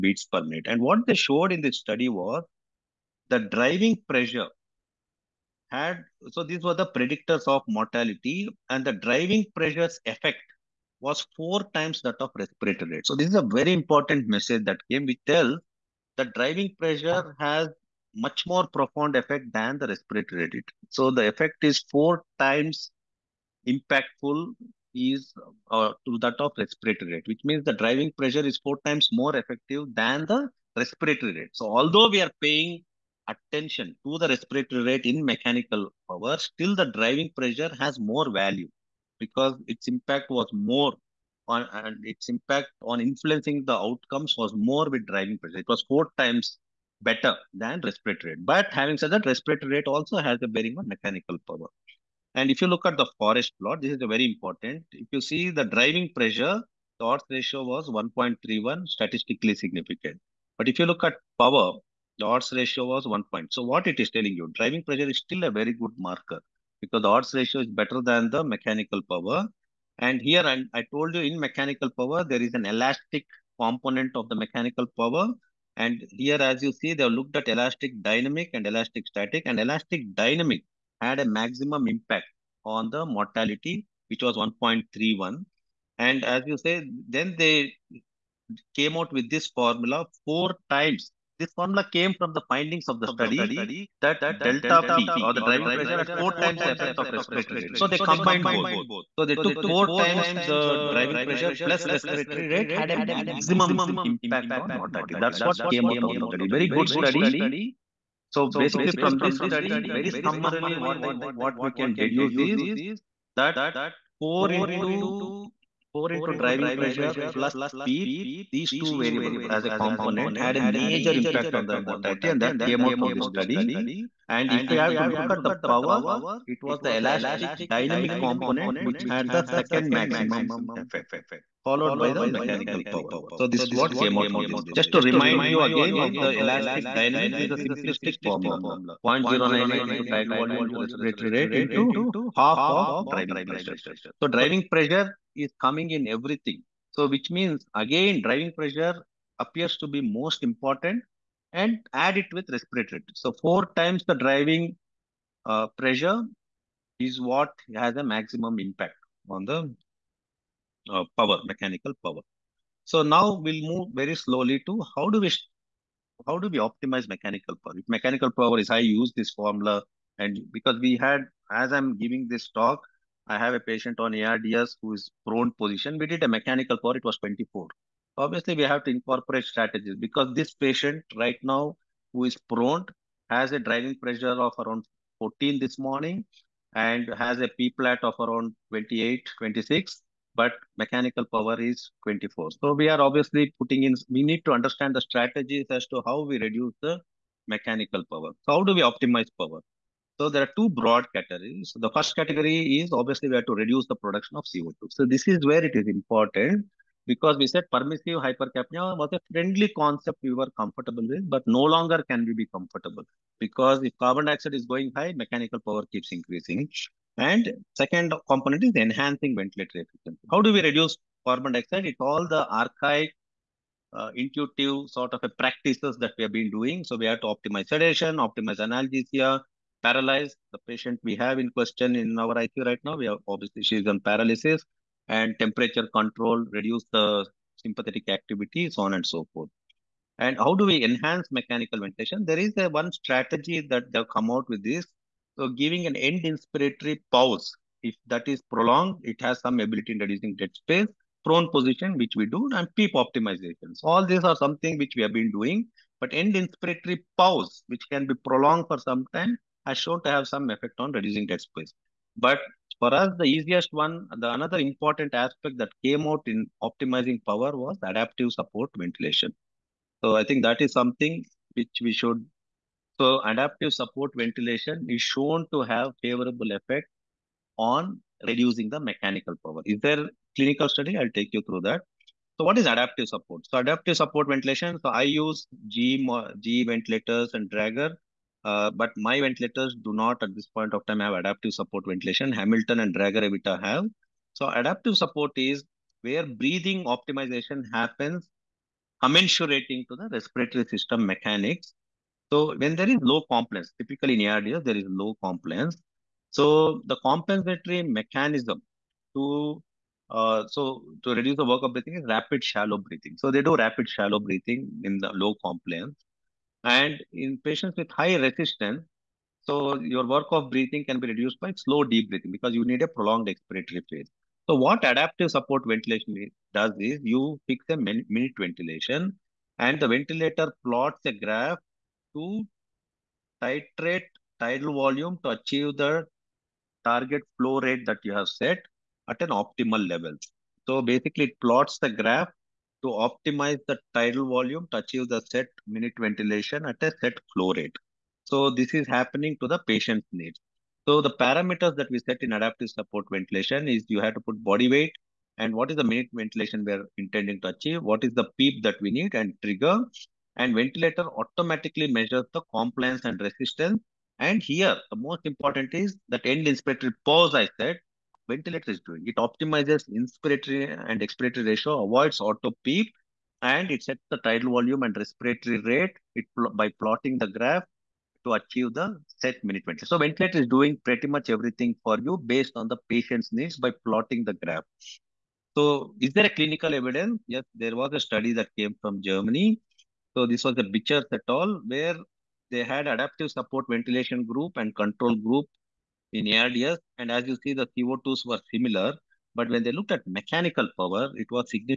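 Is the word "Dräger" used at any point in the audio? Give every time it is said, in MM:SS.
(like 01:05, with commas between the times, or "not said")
04:47, 04:52.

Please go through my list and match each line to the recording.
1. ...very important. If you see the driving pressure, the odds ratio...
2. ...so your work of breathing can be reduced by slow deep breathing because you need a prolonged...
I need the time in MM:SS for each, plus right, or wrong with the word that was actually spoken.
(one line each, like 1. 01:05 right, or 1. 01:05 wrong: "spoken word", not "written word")
1. 00:54 right
2. 05:19 right.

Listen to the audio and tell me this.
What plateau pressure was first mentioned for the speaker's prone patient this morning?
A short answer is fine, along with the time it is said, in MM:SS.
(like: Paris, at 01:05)
28, at 03:08.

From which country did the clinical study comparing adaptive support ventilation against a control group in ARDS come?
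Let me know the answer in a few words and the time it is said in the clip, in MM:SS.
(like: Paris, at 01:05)
Germany, at 06:29.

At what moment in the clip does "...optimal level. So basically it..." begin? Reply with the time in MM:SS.
05:39.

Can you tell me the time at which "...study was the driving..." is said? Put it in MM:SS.
00:01.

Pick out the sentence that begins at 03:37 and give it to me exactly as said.
And second component is enhancing ventilatory efficiency.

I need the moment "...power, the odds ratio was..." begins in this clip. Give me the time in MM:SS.
01:01.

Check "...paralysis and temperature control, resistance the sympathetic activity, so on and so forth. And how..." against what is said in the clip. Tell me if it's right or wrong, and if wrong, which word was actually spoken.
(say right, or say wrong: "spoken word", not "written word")
wrong: "reduce", not "resistance".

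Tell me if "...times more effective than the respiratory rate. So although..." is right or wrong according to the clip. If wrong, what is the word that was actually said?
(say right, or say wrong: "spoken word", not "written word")
right.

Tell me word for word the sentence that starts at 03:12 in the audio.
So we are obviously putting in, we need to understand the strategies as to how we reduce the mechanical power.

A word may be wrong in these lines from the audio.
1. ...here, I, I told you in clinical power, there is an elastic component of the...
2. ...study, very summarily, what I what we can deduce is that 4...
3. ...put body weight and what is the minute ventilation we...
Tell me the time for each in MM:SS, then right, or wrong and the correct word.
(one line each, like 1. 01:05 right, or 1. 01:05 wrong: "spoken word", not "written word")
1. 01:10 wrong: "mechanical", not "clinical"
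2. 01:49 right
3. 05:54 right.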